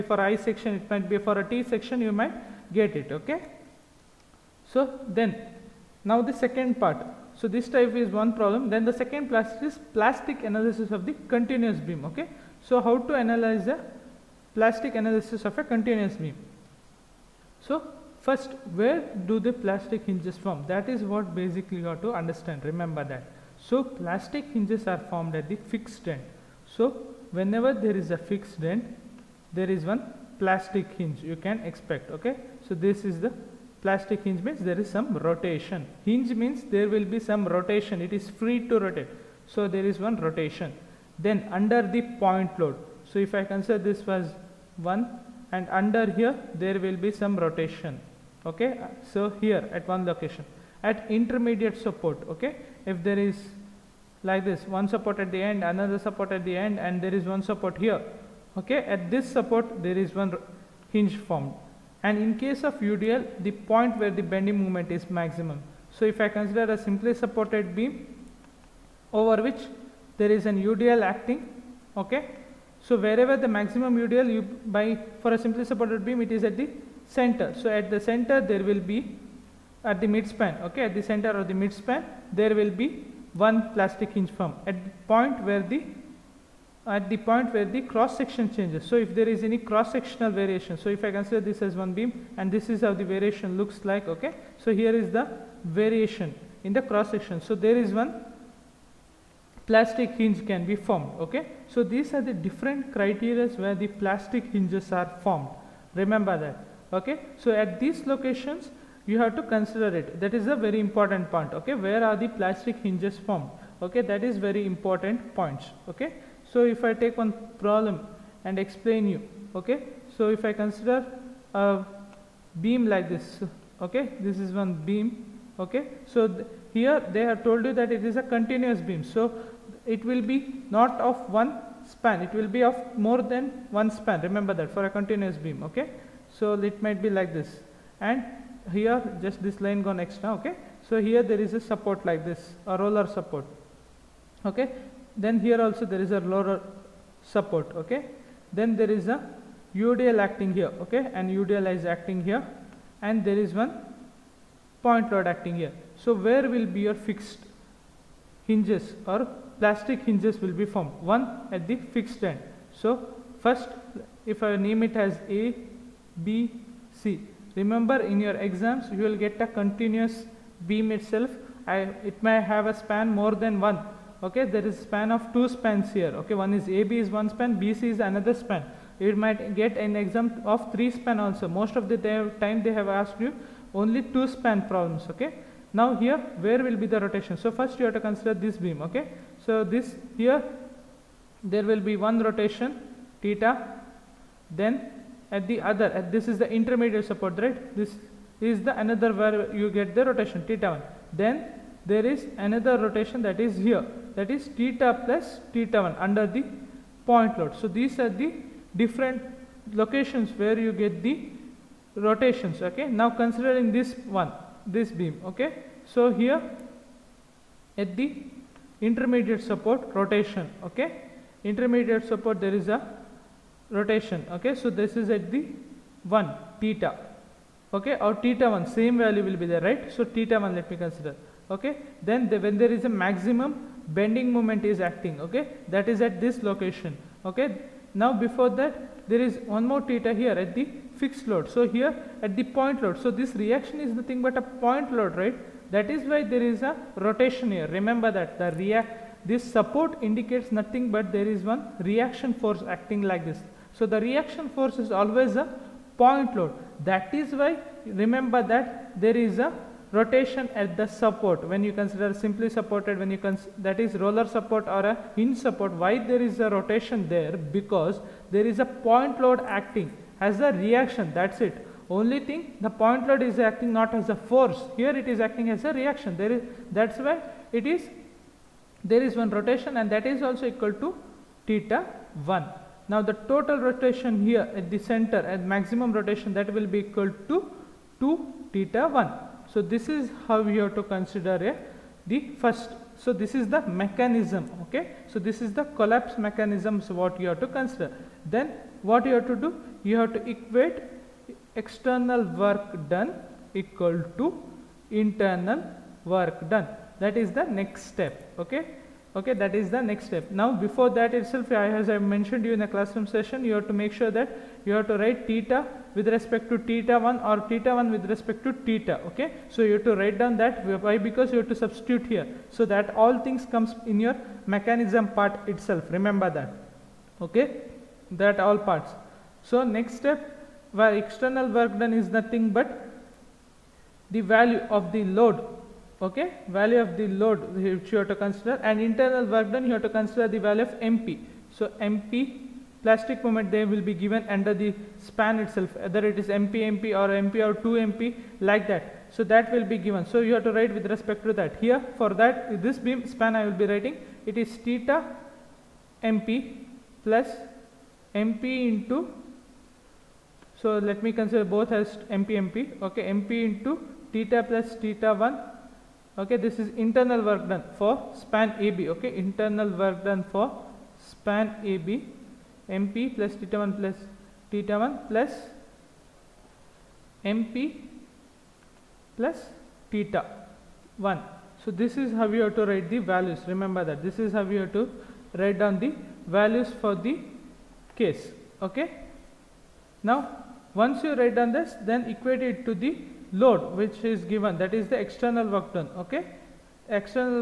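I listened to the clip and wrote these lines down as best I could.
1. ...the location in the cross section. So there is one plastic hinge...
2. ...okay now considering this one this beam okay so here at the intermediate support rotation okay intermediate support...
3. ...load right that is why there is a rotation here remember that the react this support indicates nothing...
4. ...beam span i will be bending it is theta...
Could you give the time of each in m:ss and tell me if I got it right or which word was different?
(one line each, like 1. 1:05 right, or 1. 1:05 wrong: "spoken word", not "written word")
1. 1:35 wrong: "variation", not "location"
2. 3:32 right
3. 4:04 right
4. 5:52 wrong: "writing", not "bending".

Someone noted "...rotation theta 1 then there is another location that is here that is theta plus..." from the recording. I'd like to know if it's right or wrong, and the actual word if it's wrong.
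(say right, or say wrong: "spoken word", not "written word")
wrong: "rotation", not "location".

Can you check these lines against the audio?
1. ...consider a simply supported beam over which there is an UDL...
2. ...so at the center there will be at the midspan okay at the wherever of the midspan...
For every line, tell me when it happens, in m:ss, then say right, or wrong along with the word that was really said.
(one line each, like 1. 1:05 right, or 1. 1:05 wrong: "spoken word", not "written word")
1. 1:06 right
2. 1:17 wrong: "center", not "wherever".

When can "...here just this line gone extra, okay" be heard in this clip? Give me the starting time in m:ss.
2:18.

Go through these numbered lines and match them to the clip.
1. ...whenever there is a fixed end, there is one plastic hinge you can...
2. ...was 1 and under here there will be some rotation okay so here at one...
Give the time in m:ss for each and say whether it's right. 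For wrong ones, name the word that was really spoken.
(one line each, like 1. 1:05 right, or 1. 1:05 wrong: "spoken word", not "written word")
1. 0:27 right
2. 0:44 right.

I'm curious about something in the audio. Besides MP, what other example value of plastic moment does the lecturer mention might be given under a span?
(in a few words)
2 MP.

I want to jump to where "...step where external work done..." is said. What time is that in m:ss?
5:29.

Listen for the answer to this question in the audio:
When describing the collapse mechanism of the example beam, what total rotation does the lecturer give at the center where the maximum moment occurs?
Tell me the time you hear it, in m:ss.
4:48.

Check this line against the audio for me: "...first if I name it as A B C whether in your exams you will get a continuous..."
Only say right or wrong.
wrong.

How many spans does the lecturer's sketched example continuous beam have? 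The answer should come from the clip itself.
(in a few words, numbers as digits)
2.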